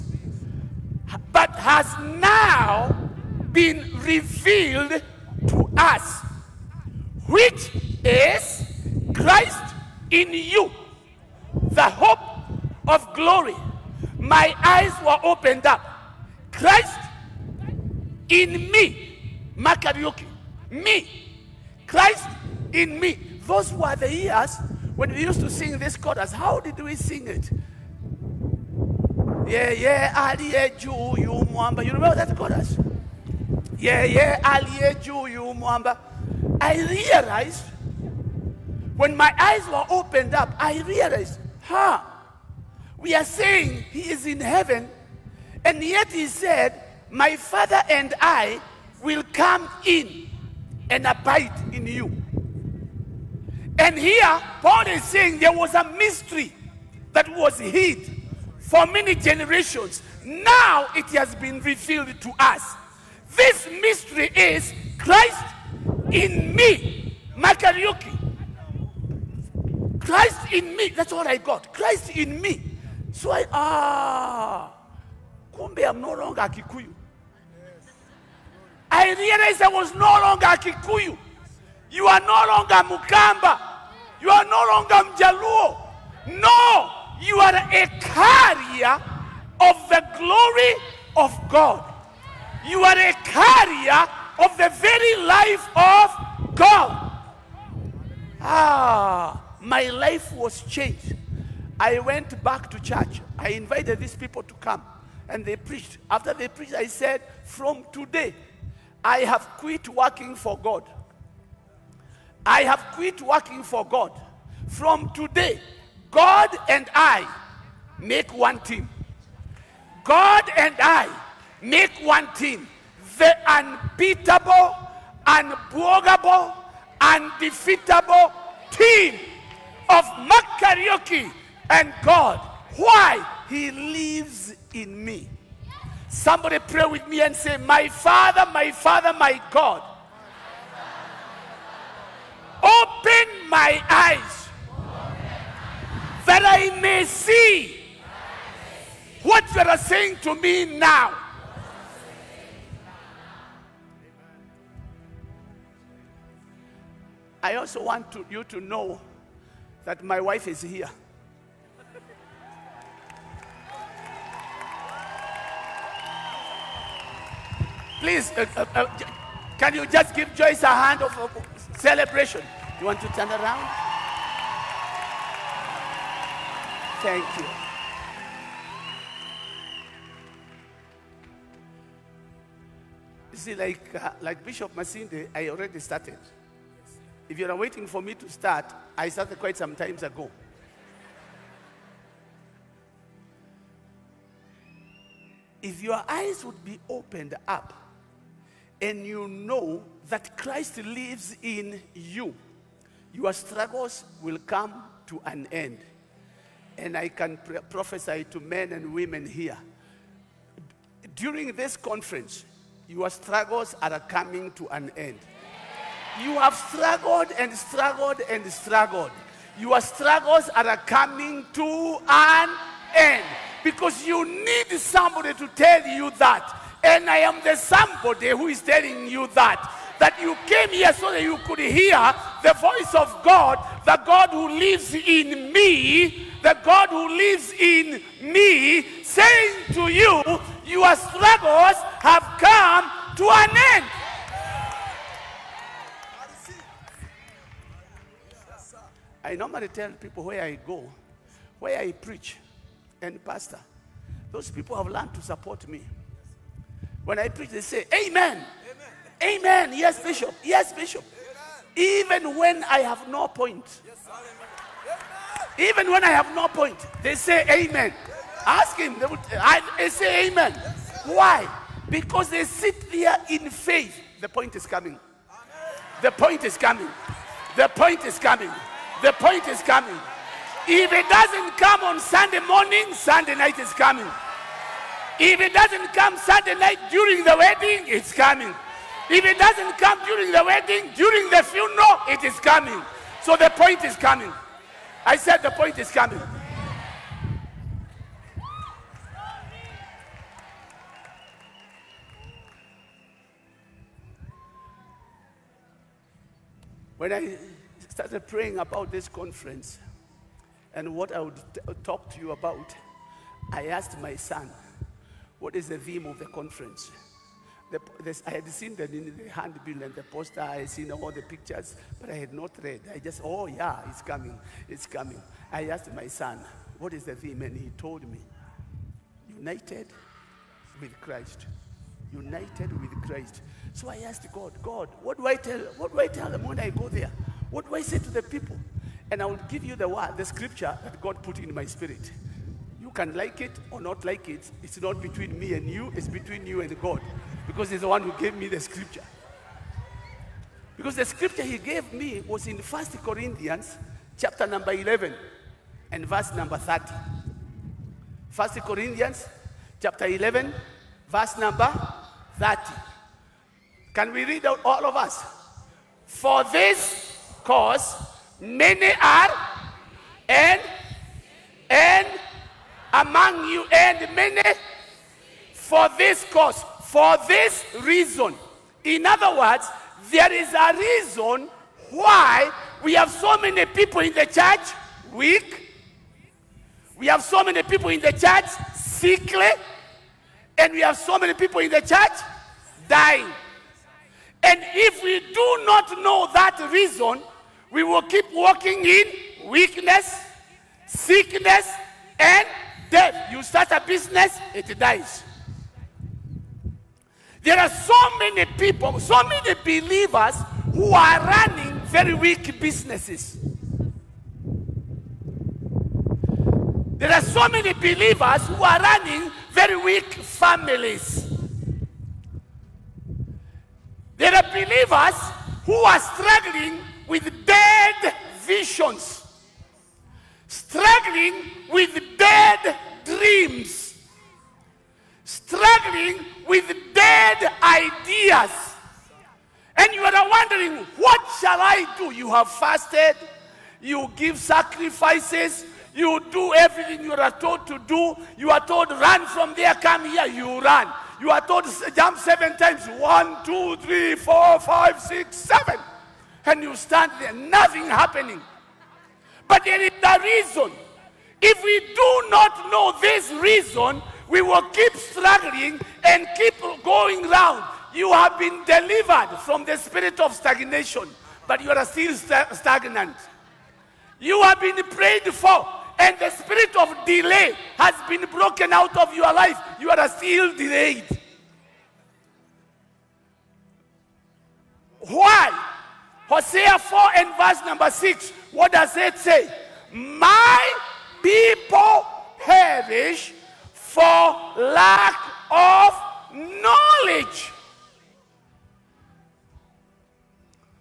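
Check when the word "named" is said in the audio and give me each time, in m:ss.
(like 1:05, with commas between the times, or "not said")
not said.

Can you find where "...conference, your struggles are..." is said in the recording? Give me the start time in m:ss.
3:31.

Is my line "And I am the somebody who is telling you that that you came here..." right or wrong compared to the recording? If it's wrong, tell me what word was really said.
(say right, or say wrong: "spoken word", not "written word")
right.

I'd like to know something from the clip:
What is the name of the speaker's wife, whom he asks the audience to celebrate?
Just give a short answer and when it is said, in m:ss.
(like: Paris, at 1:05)
Joyce, at 2:50.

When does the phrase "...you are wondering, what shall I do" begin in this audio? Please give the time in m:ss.
7:19.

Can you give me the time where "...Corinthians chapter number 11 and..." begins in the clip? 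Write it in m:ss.
5:53.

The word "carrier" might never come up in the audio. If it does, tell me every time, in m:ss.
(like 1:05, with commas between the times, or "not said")
1:27, 1:33.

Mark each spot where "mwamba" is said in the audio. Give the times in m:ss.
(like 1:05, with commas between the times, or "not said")
0:31, 0:35.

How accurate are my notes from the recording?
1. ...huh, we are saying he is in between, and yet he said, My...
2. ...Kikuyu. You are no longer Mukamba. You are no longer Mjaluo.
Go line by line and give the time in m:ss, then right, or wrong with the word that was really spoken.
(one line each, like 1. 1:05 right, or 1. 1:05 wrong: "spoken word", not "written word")
1. 0:41 wrong: "heaven", not "between"
2. 1:20 right.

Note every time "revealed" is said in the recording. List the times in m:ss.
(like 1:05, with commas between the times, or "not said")
0:03, 1:01.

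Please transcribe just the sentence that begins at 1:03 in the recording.
This mystery is Christ in me, Mark Kariuki.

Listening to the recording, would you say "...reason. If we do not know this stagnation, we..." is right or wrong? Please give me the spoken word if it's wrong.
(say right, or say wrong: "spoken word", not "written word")
wrong: "reason", not "stagnation".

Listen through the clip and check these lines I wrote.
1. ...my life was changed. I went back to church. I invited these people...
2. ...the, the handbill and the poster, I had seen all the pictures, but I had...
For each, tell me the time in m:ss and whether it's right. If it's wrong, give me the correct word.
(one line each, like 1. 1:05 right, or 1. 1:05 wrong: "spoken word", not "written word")
1. 1:39 right
2. 5:18 right.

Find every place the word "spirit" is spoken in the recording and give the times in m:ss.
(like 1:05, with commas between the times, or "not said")
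5:41, 7:49, 7:56.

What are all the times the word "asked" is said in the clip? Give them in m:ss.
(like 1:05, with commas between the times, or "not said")
5:13, 5:25, 5:34.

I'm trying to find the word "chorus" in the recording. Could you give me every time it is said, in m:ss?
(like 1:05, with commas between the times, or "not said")
0:25, 0:32.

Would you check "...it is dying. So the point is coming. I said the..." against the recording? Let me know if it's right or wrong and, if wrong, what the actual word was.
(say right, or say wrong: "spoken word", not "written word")
wrong: "coming", not "dying".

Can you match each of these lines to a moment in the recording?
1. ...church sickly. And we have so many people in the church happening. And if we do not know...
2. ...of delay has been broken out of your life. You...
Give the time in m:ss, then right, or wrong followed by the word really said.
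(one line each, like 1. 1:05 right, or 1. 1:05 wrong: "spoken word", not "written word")
1. 6:28 wrong: "dying", not "happening"
2. 7:56 right.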